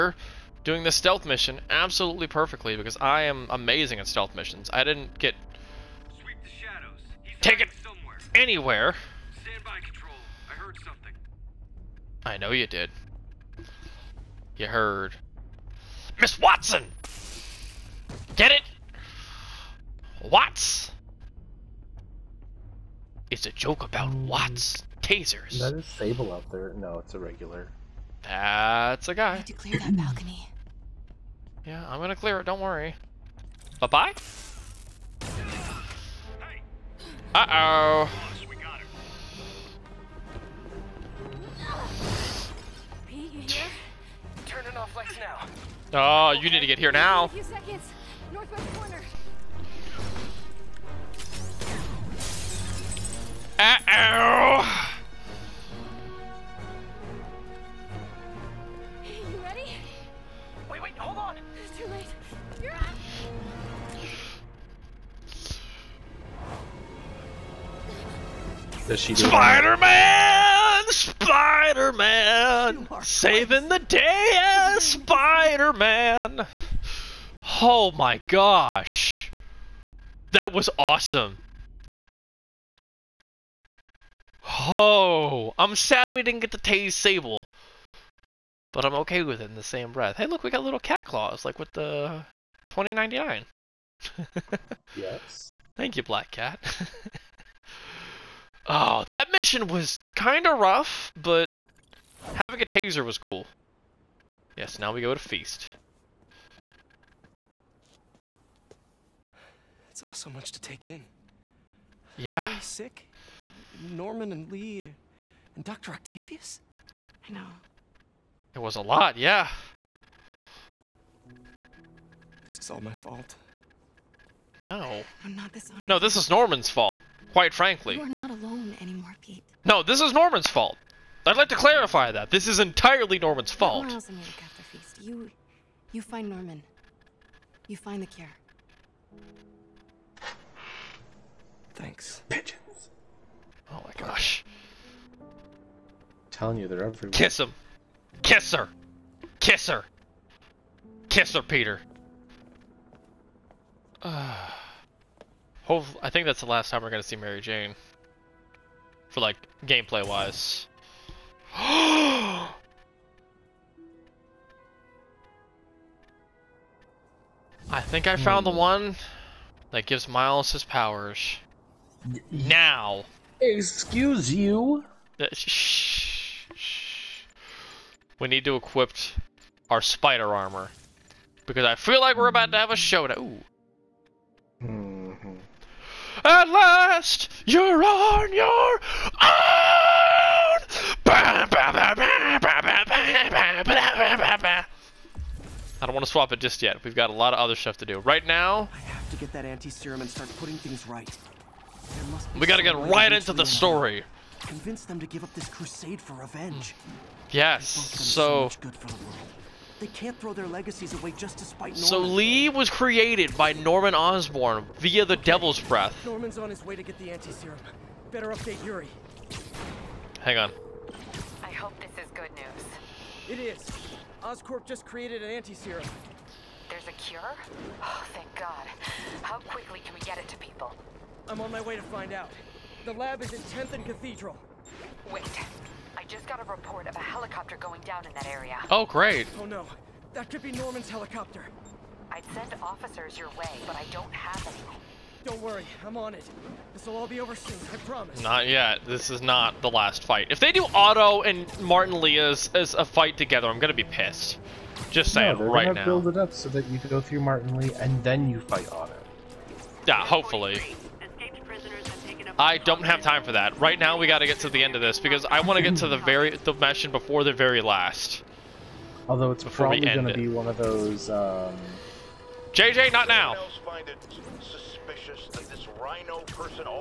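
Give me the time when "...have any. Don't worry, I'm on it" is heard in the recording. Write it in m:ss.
4:04.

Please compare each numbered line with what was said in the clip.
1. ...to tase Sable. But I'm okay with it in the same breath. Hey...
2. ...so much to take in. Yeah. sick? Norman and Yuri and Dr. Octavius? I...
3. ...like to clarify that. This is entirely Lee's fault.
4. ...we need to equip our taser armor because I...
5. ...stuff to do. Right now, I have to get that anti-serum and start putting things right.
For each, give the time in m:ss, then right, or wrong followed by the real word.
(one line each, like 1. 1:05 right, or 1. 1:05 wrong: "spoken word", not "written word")
1. 1:26 right
2. 1:50 wrong: "Lee", not "Yuri"
3. 2:11 wrong: "Norman", not "Lee"
4. 2:58 wrong: "spider", not "taser"
5. 3:17 right.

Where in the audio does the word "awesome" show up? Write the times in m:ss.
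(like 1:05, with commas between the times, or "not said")
1:20.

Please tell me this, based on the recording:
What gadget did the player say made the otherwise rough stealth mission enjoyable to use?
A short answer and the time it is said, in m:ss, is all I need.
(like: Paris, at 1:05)
Taser, at 1:42.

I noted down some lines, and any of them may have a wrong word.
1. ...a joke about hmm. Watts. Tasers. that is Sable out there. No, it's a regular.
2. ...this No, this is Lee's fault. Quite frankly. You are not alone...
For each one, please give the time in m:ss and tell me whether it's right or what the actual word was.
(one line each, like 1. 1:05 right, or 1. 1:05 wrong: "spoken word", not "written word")
1. 0:23 right
2. 2:05 wrong: "Norman", not "Lee".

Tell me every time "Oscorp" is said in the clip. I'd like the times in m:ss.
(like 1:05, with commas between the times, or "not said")
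3:44.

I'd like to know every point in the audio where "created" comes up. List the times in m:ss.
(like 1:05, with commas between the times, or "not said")
3:32, 3:44.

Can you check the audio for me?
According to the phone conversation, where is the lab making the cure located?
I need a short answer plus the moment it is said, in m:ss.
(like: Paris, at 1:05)
10th and Cathedral, at 3:53.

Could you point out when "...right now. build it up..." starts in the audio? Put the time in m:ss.
4:15.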